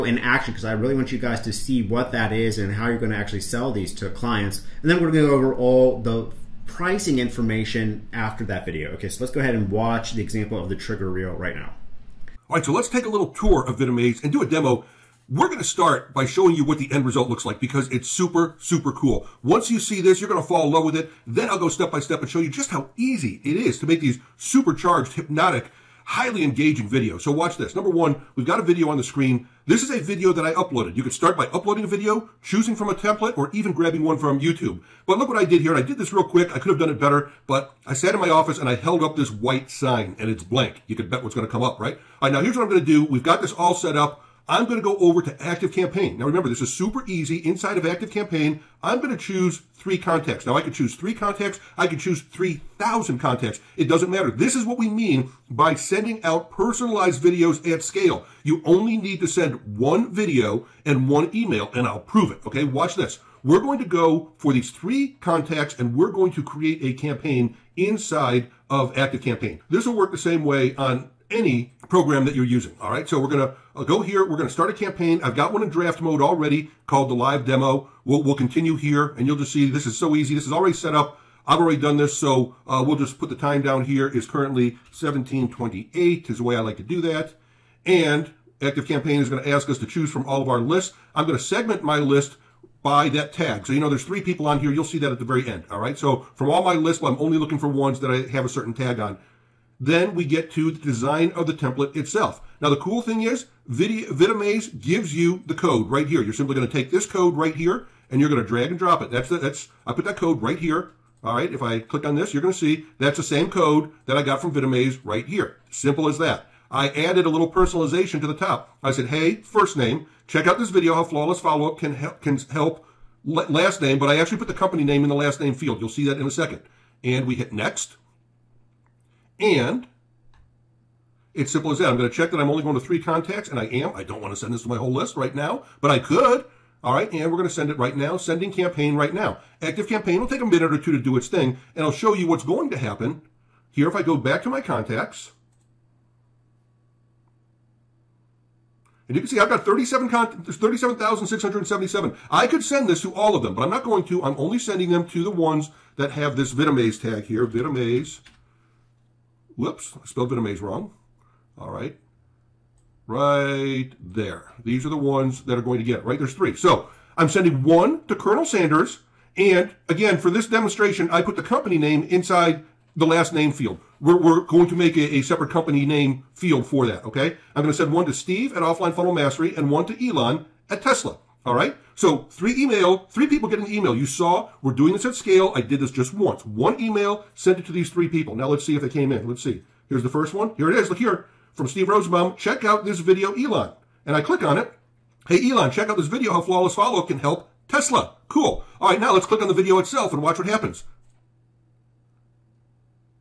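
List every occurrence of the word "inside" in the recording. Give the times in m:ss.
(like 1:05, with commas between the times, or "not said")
0:47, 1:07, 2:52.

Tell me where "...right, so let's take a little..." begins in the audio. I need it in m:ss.
0:12.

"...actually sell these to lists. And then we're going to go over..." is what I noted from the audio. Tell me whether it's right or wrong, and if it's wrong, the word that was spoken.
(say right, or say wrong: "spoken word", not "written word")
wrong: "clients", not "lists".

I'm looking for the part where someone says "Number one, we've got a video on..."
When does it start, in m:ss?
0:27.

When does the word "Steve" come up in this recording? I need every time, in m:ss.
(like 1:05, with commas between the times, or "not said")
2:58, 3:11.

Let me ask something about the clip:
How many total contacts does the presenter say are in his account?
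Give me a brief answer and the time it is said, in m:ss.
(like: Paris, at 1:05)
37,677, at 2:29.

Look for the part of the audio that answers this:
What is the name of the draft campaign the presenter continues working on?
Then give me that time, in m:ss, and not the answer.
1:17.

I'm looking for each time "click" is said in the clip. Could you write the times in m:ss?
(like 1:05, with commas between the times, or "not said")
1:51, 3:14, 3:19.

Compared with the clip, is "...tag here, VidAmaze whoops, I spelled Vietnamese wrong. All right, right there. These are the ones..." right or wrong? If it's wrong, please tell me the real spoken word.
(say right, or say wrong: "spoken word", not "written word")
right.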